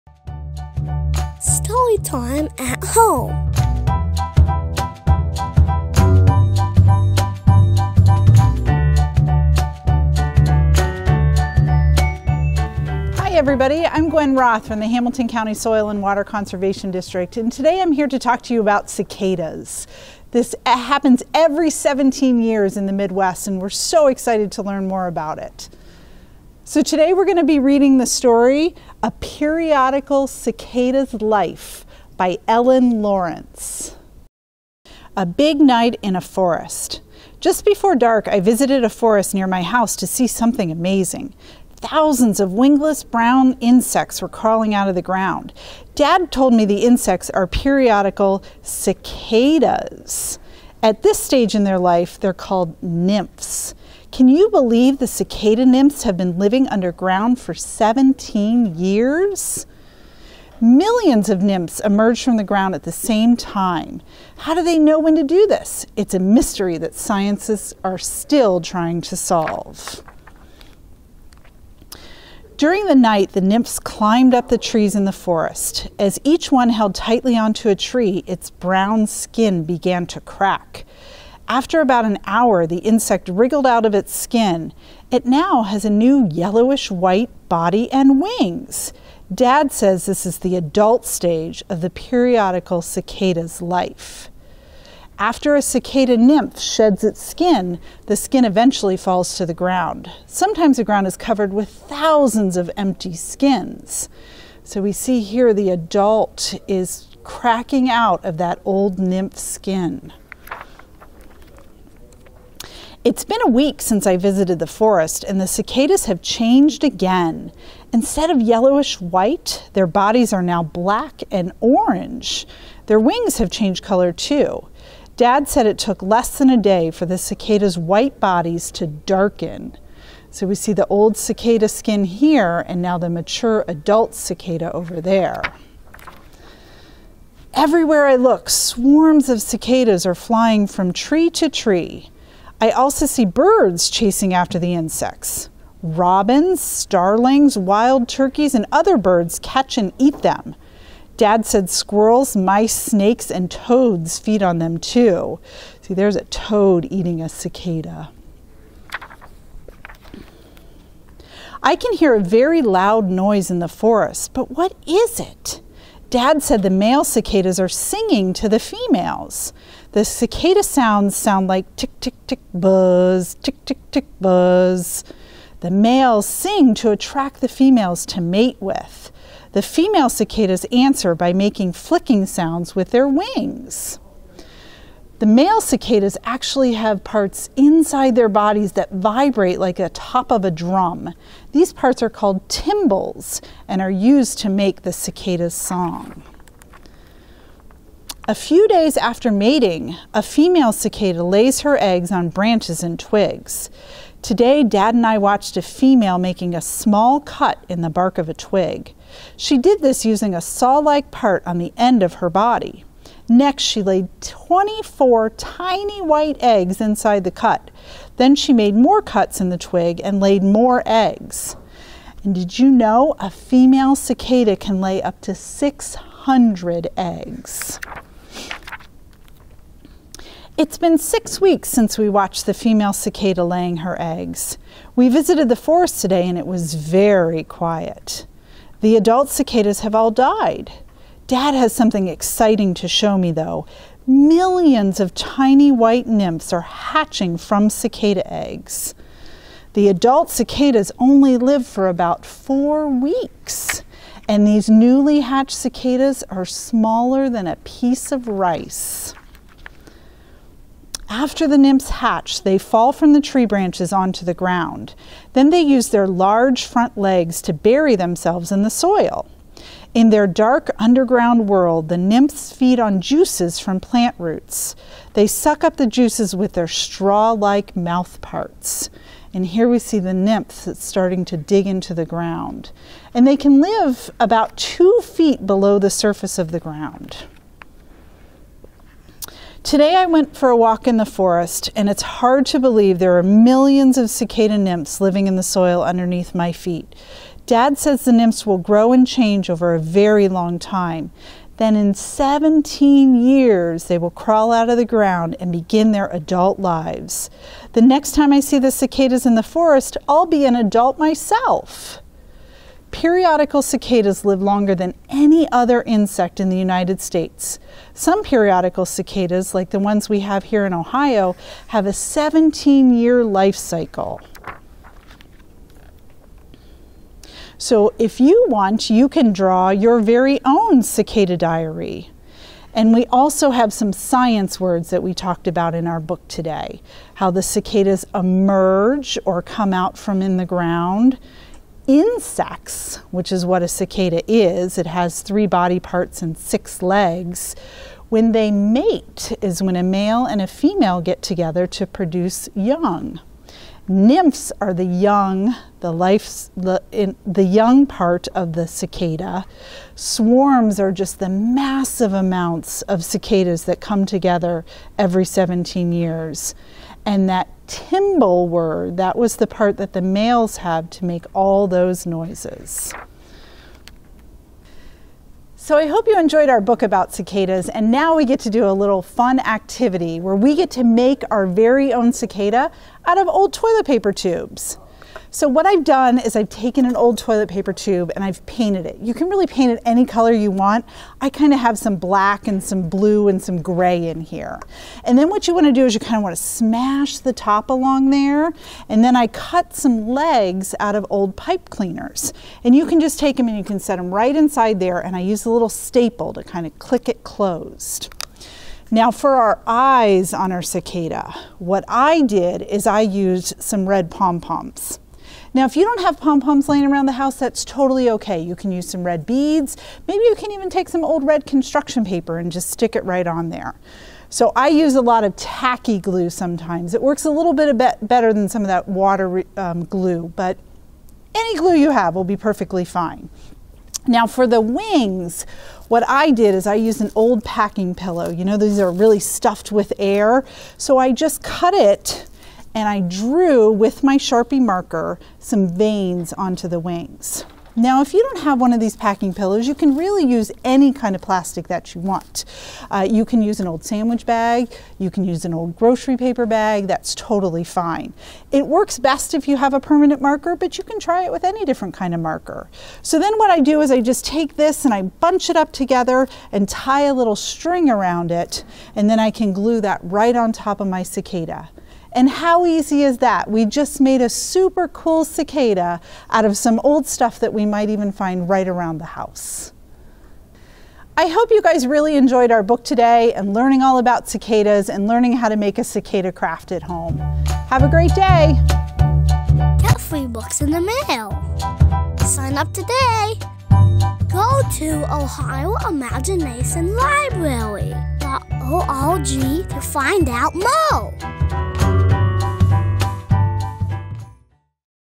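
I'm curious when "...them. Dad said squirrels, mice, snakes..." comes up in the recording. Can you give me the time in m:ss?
2:30.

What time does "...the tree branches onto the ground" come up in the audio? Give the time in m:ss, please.
4:23.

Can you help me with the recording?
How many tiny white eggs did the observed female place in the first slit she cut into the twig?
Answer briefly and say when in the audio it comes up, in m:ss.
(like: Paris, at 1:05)
24, at 3:34.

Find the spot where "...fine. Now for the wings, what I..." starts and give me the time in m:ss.
7:12.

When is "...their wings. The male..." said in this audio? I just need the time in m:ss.
3:02.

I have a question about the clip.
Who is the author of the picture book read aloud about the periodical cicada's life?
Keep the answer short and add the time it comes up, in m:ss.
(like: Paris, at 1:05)
Ellen Lawrence, at 0:32.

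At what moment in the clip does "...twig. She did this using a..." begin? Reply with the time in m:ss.
3:28.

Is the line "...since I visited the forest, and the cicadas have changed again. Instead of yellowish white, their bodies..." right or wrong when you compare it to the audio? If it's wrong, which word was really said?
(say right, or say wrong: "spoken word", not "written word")
right.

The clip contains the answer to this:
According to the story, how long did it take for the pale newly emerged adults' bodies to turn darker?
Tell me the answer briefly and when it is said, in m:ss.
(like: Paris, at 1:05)
Less than a day, at 2:06.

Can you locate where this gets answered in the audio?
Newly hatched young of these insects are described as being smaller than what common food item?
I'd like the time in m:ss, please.
4:17.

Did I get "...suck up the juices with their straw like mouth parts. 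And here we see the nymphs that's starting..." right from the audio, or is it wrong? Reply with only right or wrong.
right.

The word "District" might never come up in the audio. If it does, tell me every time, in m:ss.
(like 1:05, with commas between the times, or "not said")
0:16.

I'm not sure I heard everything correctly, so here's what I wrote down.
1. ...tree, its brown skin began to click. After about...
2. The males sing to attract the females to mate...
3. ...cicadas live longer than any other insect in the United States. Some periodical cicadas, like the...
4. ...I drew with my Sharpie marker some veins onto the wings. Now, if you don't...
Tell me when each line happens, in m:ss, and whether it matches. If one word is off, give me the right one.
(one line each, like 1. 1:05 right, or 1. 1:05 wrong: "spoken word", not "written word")
1. 1:17 wrong: "crack", not "click"
2. 2:55 right
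3. 5:13 right
4. 7:22 right.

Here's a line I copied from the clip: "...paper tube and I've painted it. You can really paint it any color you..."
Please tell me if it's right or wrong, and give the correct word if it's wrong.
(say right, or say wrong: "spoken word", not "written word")
right.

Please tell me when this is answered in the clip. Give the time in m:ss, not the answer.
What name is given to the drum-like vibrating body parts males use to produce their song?
3:12.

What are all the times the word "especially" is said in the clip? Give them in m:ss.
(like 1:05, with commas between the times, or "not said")
not said.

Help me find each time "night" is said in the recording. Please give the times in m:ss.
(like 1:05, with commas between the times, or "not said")
0:35, 1:12.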